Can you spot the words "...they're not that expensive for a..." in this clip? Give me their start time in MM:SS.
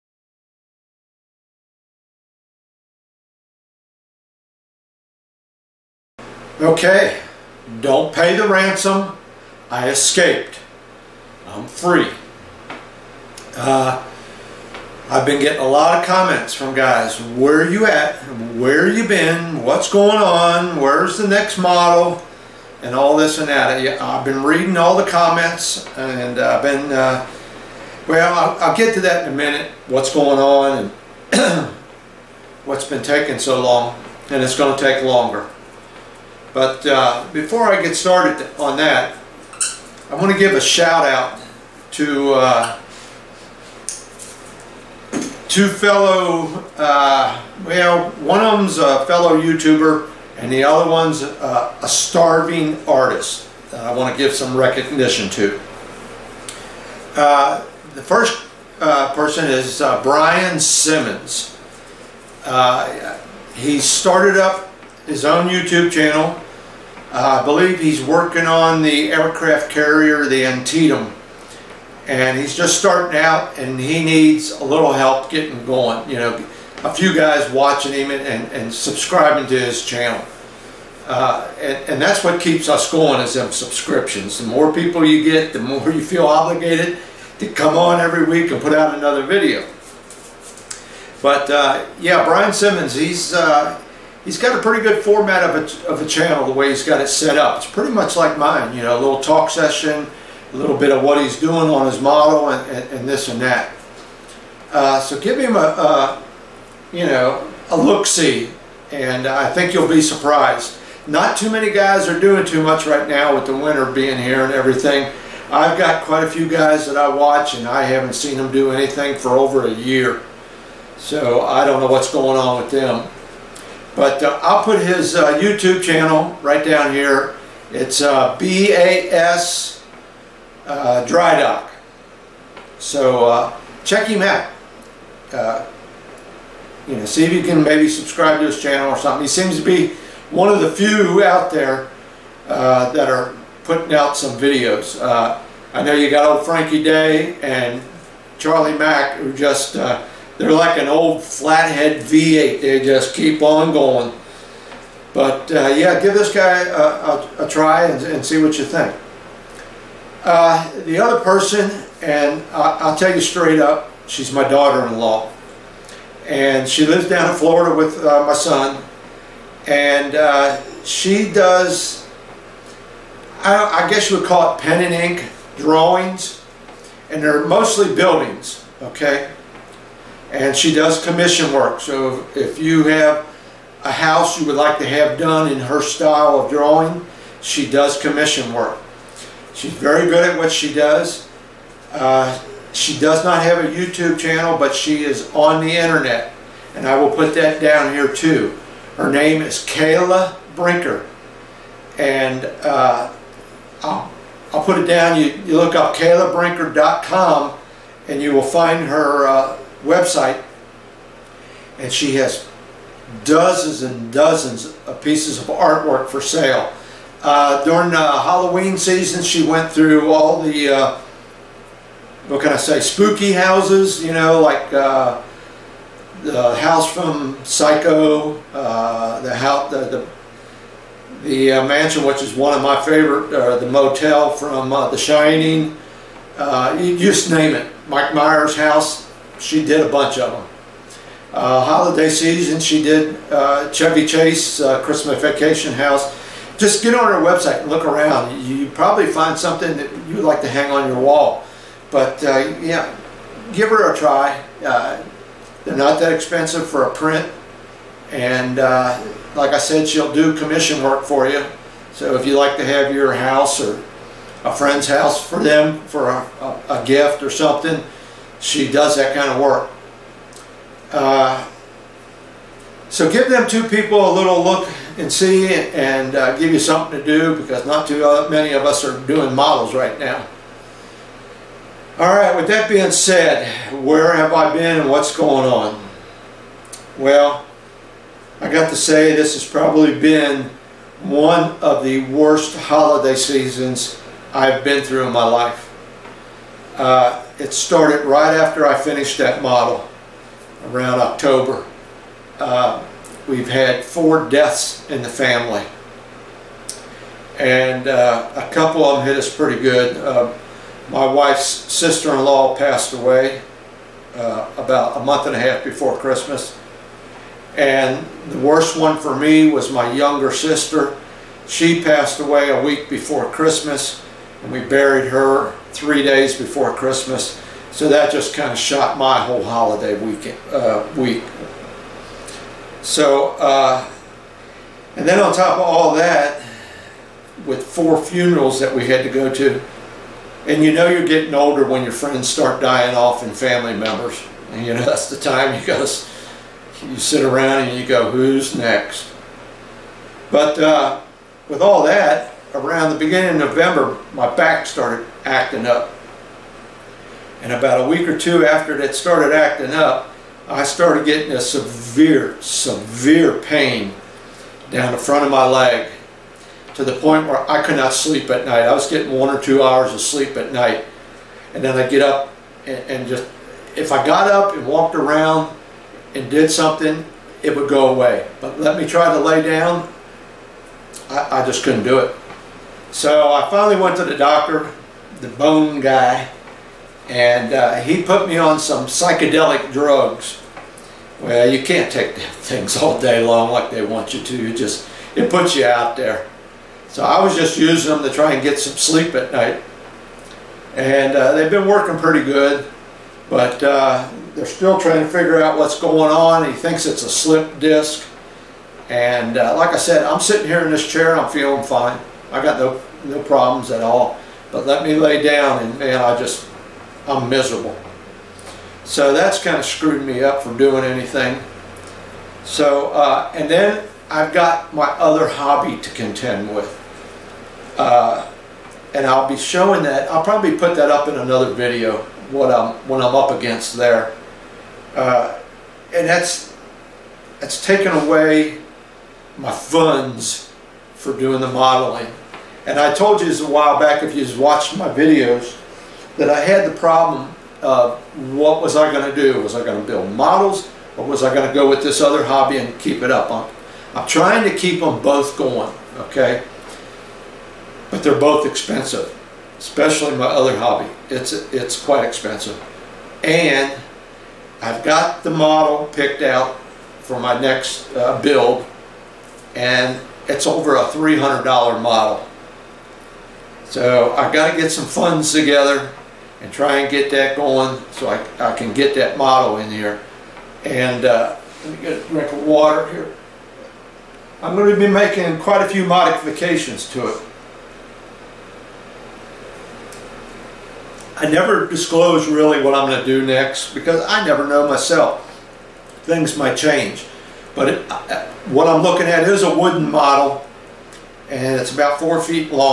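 04:15.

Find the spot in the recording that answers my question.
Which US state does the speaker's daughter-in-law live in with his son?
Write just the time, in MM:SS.
02:47.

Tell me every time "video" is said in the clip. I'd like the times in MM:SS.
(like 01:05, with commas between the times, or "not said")
01:29, 02:24, 07:11, 07:24.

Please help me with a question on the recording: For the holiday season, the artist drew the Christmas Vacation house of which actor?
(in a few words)
Chevy Chase.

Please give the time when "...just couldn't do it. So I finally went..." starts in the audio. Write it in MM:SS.
06:21.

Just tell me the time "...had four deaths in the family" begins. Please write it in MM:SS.
05:03.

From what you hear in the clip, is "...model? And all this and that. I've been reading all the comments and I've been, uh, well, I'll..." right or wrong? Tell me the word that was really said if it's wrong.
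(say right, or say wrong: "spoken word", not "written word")
right.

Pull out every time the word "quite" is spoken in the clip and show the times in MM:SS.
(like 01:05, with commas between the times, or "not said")
01:56, 07:41, 08:05.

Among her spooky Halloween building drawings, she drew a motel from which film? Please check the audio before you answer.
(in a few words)
The Shining.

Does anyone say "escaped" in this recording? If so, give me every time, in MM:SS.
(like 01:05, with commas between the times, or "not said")
00:09.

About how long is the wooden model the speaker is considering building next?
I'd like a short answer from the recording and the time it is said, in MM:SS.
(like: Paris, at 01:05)
4 feet, at 08:21.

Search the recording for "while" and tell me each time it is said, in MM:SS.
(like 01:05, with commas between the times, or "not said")
07:23.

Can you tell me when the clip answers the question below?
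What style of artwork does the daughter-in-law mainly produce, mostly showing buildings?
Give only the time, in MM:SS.
02:54.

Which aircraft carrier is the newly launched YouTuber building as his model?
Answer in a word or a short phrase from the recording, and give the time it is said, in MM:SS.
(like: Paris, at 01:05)
Antietam, at 01:10.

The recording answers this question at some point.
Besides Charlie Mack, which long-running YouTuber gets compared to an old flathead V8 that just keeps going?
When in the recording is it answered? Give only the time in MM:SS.
02:26.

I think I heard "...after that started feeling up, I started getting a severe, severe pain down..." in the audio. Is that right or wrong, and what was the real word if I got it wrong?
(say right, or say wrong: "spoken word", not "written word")
wrong: "acting", not "feeling".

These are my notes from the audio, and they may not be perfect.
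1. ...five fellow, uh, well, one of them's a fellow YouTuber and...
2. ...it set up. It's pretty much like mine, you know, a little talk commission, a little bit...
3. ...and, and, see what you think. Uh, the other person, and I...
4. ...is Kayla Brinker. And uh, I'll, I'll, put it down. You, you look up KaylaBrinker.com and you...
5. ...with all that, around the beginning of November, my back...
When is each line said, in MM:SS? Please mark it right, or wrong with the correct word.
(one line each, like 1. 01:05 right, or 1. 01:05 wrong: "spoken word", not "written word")
1. 00:45 wrong: "two", not "five"
2. 01:37 wrong: "session", not "commission"
3. 02:37 right
4. 03:19 right
5. 05:51 right.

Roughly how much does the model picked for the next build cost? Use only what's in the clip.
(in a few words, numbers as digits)
Over $300.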